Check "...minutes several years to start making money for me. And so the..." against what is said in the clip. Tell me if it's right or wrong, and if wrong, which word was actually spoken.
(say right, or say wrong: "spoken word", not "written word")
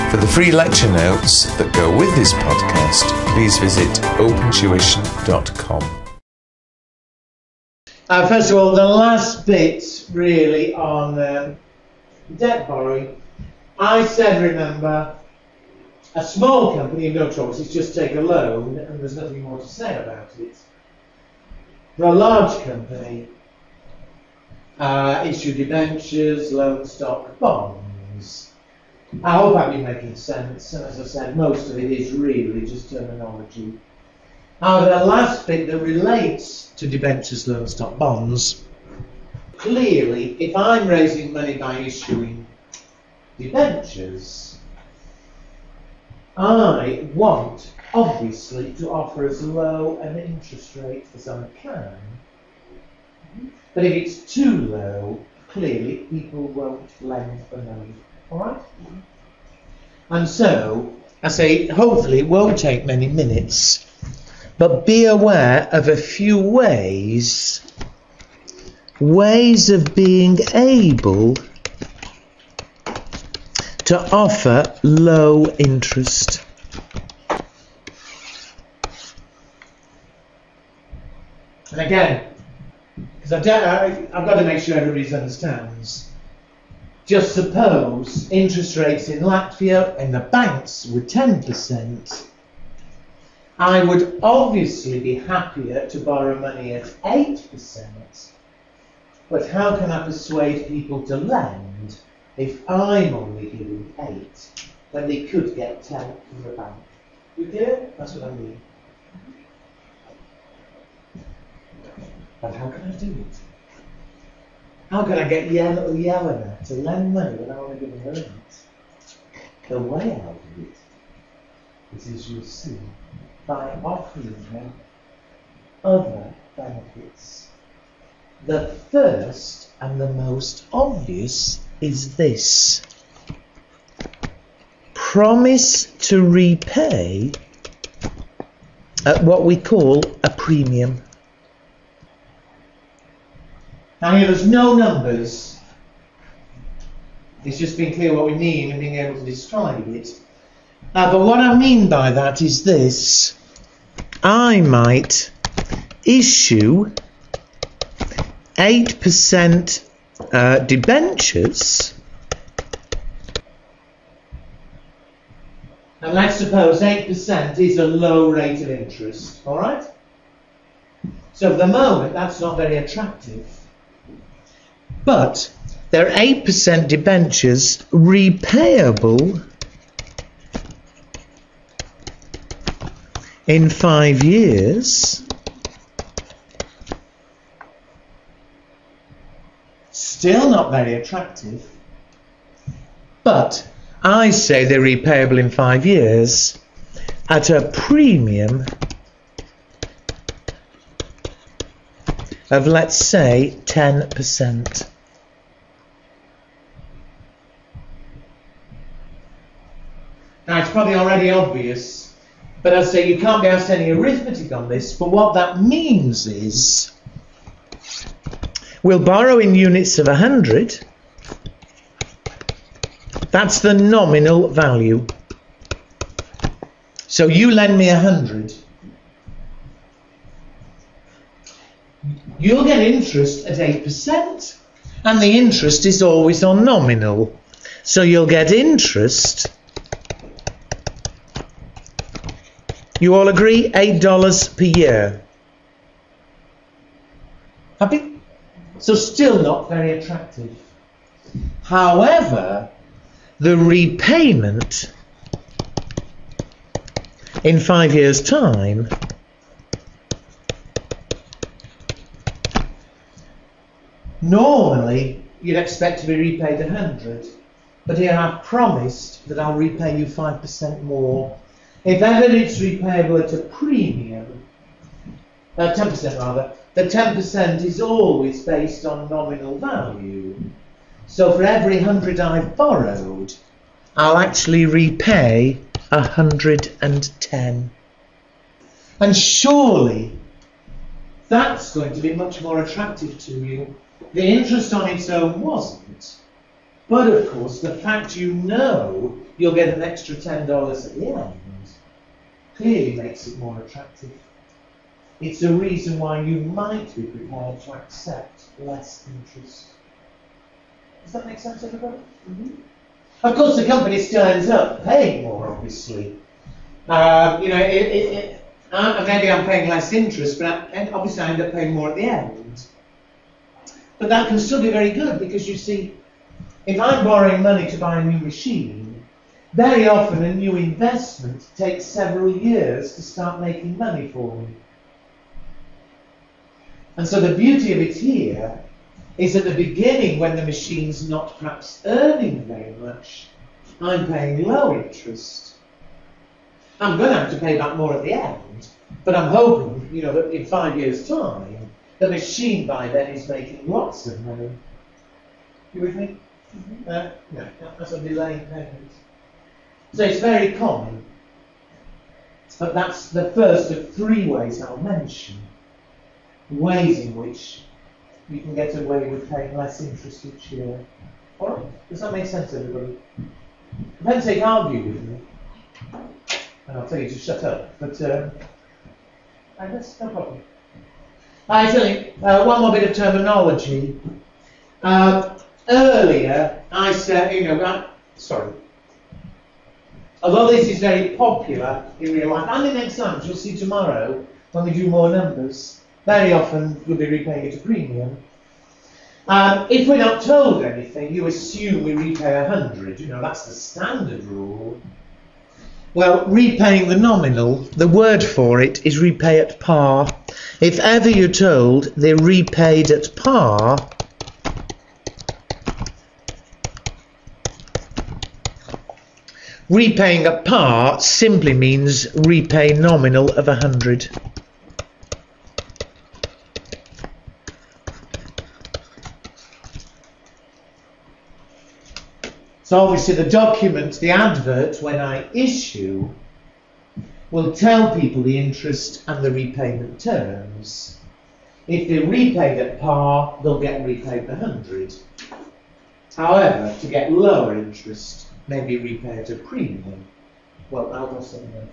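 wrong: "takes", not "minutes".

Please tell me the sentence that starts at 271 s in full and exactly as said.
If ever it's repayable at a premium, uh, 10% rather, the 10% is always based on nominal value.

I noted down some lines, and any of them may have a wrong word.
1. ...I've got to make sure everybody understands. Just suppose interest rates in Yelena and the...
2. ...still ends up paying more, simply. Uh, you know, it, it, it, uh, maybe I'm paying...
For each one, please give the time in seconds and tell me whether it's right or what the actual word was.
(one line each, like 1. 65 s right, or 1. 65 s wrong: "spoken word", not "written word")
1. 84 s wrong: "Latvia", not "Yelena"
2. 313 s wrong: "obviously", not "simply".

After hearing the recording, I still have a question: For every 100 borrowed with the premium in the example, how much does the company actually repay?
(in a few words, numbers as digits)
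110.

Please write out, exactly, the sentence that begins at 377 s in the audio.
But, um, I guess no problem.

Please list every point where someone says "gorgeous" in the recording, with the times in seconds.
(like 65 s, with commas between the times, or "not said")
not said.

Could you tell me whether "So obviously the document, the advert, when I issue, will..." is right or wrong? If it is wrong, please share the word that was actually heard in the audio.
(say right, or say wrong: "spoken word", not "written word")
right.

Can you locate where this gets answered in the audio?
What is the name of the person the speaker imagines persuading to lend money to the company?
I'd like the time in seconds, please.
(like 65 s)
115 s.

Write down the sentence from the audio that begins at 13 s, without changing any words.
I said, remember, a small company in no trouble, it's just take a loan and there's nothing more to say about it.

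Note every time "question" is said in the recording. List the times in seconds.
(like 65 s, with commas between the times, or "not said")
not said.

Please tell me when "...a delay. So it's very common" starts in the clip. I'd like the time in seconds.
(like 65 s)
357 s.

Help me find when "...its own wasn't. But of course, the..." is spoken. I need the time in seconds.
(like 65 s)
294 s.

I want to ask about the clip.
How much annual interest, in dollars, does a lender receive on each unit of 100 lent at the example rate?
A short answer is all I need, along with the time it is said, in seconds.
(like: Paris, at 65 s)
$8, at 243 s.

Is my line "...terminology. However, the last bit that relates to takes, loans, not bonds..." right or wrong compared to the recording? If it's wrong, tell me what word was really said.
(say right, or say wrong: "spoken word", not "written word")
wrong: "debentures", not "takes".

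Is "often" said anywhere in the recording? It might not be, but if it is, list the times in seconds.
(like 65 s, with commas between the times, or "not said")
329 s, 396 s.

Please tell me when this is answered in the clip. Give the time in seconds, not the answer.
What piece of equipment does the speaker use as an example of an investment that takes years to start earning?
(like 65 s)
327 s.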